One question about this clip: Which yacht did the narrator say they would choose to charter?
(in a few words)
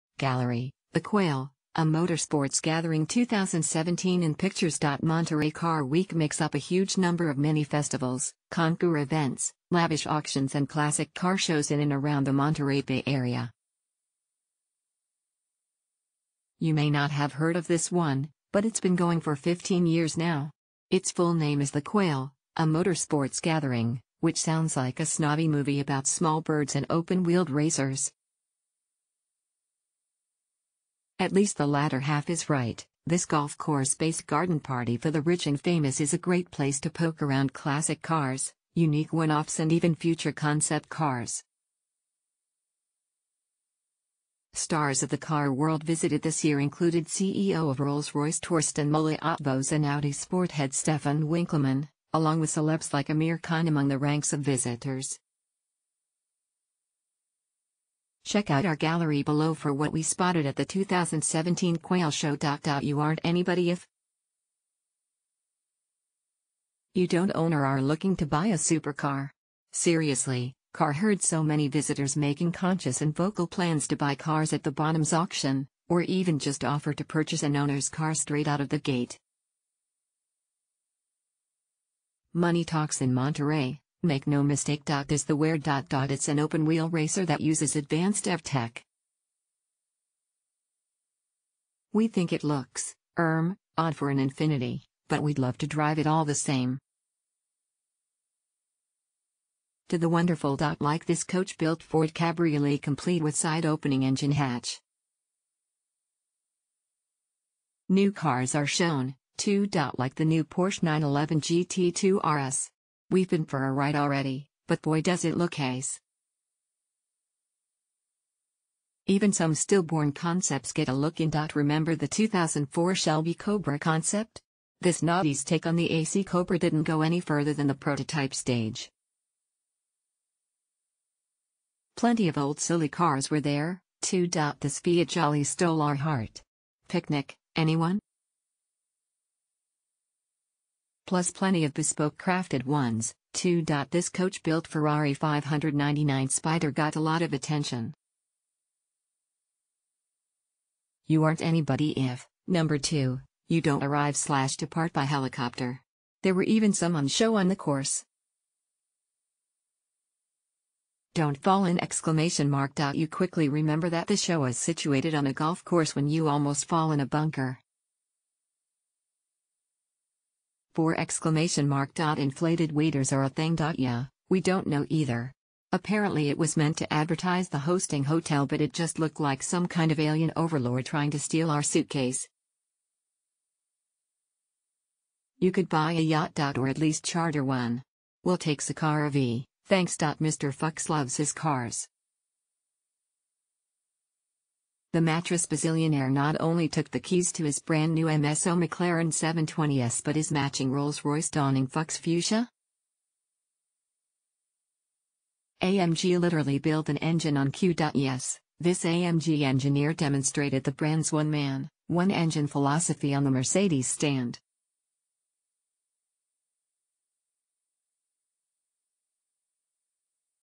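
Sakara V.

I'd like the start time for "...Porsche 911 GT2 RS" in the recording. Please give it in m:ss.
1:50.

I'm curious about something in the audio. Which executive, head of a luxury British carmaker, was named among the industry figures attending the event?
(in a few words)
Torsten Müller-Ötvös.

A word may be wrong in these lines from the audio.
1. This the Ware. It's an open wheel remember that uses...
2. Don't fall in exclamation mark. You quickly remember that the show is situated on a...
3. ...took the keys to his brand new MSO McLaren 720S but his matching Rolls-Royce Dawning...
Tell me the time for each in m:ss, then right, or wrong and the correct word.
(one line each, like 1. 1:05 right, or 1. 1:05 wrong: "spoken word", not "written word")
1. 1:24 wrong: "racer", not "remember"
2. 2:41 right
3. 3:16 right.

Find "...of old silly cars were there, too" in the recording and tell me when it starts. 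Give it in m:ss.
2:12.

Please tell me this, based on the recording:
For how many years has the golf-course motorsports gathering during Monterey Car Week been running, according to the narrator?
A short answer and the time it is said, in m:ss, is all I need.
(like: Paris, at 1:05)
15, at 0:19.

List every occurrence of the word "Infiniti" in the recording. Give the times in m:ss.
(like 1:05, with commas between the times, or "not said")
1:34.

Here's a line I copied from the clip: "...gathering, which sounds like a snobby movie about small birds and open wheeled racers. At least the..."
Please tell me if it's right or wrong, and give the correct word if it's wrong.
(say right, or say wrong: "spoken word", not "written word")
right.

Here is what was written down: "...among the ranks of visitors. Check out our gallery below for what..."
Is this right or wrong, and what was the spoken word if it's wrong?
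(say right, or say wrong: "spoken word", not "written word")
right.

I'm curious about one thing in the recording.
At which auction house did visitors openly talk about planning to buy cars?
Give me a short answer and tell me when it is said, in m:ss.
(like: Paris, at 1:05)
Bonhams, at 1:14.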